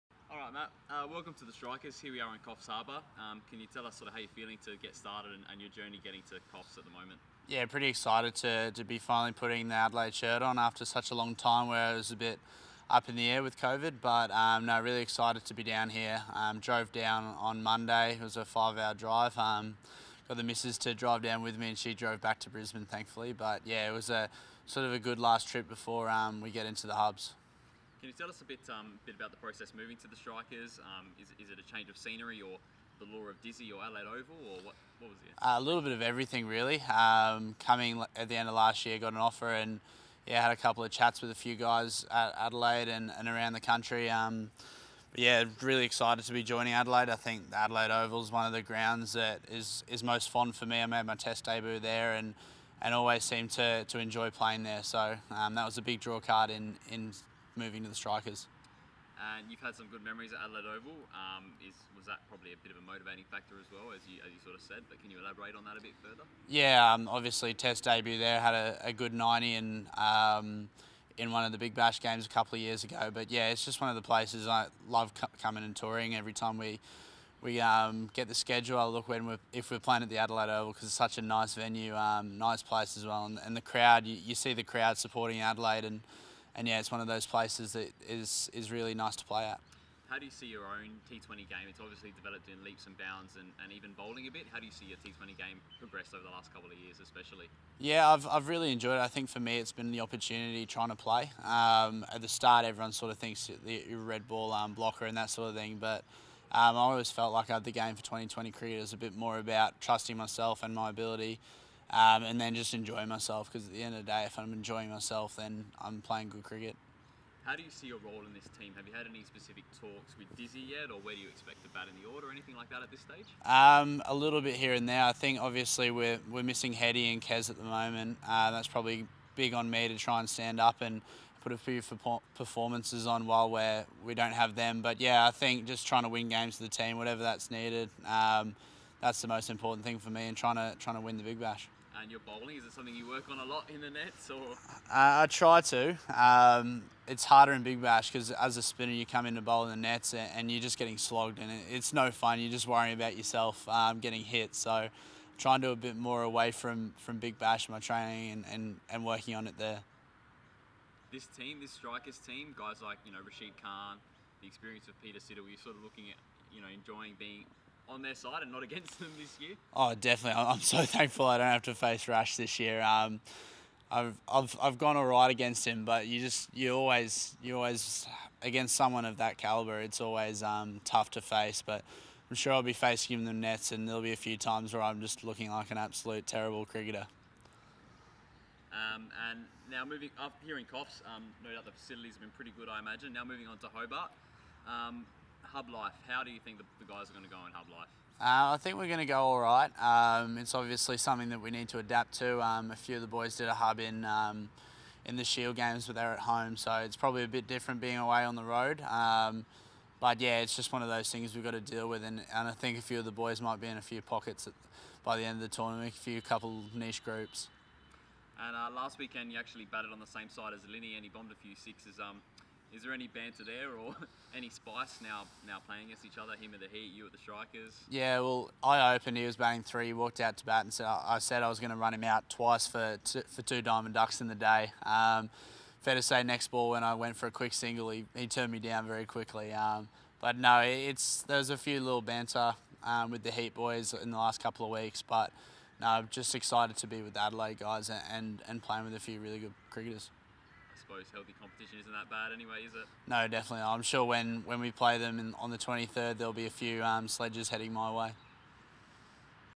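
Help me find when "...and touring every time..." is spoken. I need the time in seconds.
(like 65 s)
75 s.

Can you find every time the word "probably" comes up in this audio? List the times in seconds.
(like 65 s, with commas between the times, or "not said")
62 s, 128 s, 206 s.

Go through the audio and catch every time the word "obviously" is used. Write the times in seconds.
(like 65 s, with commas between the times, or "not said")
67 s, 91 s, 125 s, 200 s.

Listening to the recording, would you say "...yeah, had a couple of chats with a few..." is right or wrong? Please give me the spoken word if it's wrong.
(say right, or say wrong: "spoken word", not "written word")
right.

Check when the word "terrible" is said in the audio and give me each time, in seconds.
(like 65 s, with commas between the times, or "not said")
186 s.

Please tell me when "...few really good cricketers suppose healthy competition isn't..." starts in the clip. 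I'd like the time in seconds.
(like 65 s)
248 s.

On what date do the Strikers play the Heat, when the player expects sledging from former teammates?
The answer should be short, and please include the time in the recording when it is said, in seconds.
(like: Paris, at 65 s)
23rd, at 255 s.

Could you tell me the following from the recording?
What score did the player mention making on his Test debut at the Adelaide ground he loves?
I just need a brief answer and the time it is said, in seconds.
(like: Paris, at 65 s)
90, at 69 s.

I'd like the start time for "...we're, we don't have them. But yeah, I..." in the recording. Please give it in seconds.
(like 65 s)
133 s.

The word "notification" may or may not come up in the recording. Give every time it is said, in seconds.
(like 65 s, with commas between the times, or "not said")
not said.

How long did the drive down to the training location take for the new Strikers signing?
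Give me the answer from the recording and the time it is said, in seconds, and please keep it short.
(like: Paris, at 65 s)
5 hours, at 18 s.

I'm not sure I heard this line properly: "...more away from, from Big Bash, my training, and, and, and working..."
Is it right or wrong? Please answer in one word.
right.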